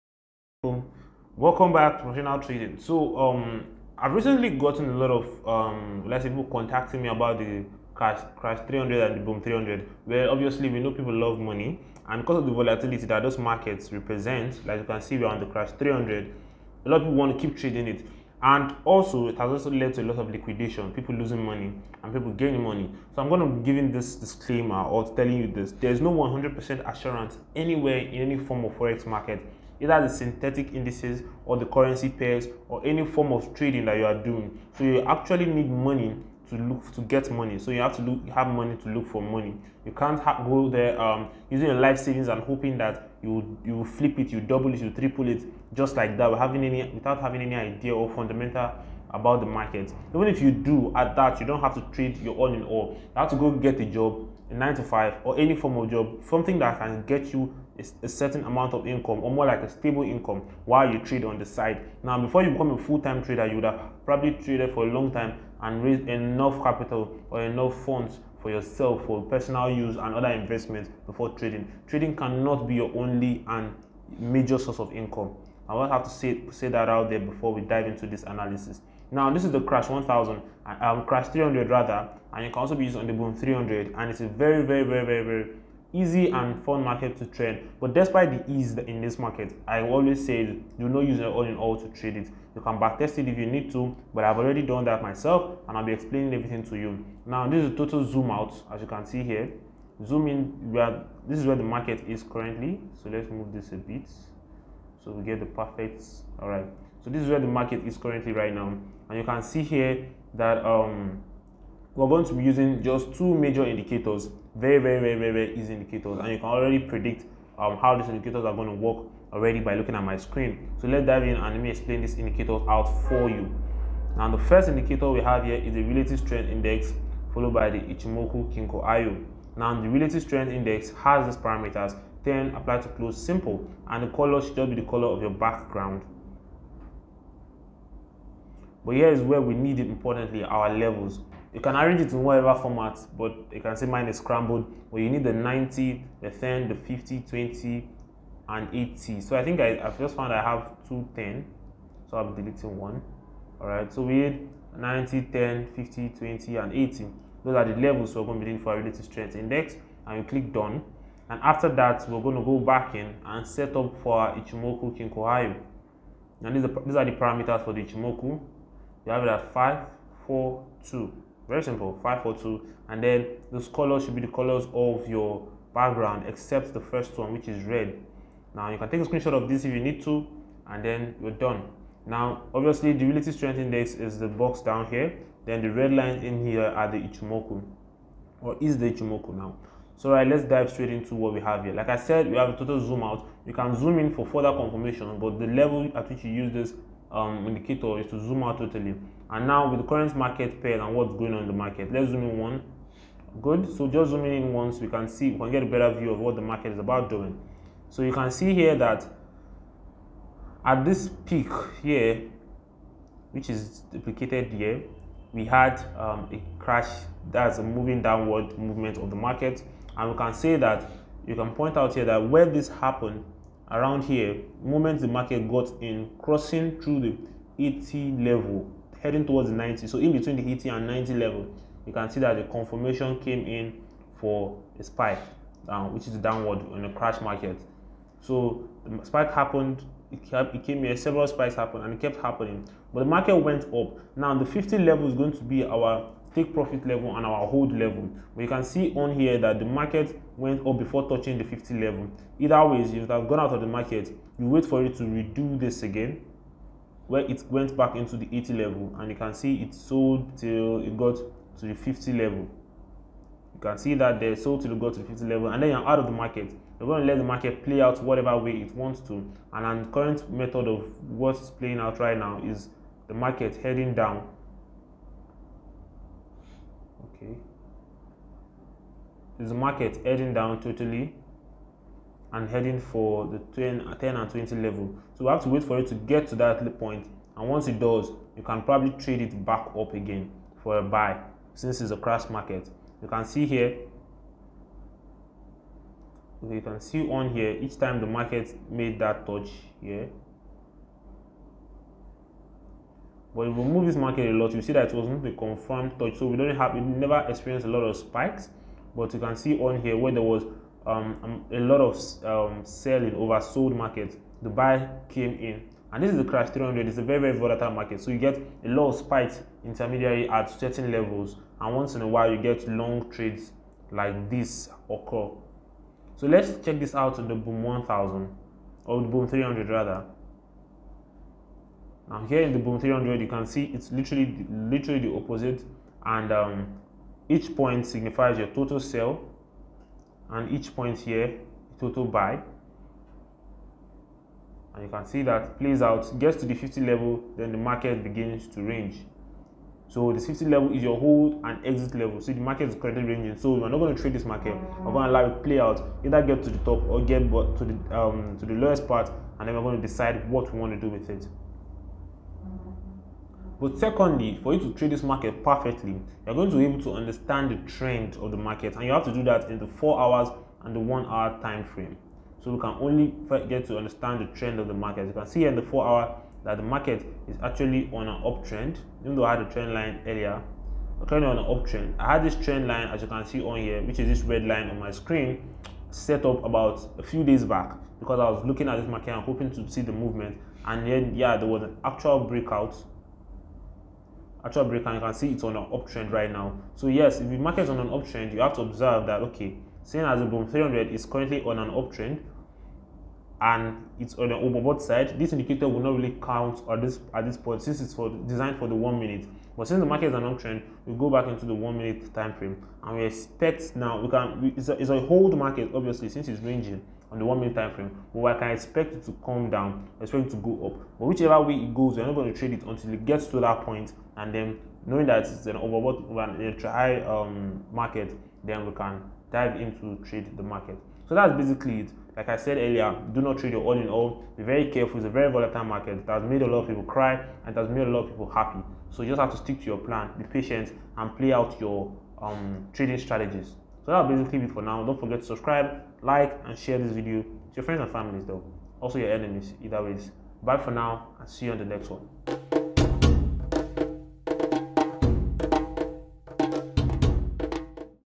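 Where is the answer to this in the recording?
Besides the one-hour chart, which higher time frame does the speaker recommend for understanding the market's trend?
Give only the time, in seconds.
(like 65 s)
369 s.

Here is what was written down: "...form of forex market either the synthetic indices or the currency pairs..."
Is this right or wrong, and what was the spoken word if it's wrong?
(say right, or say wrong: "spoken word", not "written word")
right.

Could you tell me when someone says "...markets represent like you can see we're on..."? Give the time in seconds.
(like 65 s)
13 s.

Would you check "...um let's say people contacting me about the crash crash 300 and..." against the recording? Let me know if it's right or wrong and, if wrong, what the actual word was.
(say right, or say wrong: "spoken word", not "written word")
right.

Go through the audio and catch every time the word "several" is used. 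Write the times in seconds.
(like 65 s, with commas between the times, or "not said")
240 s.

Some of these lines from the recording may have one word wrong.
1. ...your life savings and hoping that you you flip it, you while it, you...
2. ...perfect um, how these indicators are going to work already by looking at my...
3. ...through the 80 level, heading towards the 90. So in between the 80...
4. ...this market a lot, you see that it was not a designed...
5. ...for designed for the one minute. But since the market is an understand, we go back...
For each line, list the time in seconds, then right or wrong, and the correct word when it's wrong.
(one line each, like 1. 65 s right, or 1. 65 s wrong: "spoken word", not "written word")
1. 41 s wrong: "double", not "while"
2. 116 s wrong: "predict", not "perfect"
3. 226 s right
4. 303 s wrong: "confirmed", not "designed"
5. 407 s wrong: "uptrend", not "understand".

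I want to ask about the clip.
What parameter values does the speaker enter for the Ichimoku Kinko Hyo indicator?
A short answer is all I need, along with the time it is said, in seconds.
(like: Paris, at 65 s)
5, 4, 2, at 169 s.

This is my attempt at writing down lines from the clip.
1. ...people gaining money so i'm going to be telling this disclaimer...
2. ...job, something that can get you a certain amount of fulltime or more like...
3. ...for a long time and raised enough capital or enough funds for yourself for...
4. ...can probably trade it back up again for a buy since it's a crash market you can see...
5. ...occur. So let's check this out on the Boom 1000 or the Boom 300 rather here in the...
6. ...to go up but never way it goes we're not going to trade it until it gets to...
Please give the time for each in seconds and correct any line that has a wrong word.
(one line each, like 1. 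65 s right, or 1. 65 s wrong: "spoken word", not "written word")
1. 22 s wrong: "giving", not "telling"
2. 55 s wrong: "income", not "fulltime"
3. 64 s right
4. 288 s right
5. 324 s right
6. 420 s wrong: "whichever", not "never".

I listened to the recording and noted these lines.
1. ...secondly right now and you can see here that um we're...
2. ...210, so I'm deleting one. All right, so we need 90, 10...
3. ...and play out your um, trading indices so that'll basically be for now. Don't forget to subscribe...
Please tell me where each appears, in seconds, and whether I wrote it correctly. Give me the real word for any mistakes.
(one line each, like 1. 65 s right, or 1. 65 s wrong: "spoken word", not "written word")
1. 107 s wrong: "currently", not "secondly"
2. 150 s right
3. 440 s wrong: "strategies", not "indices".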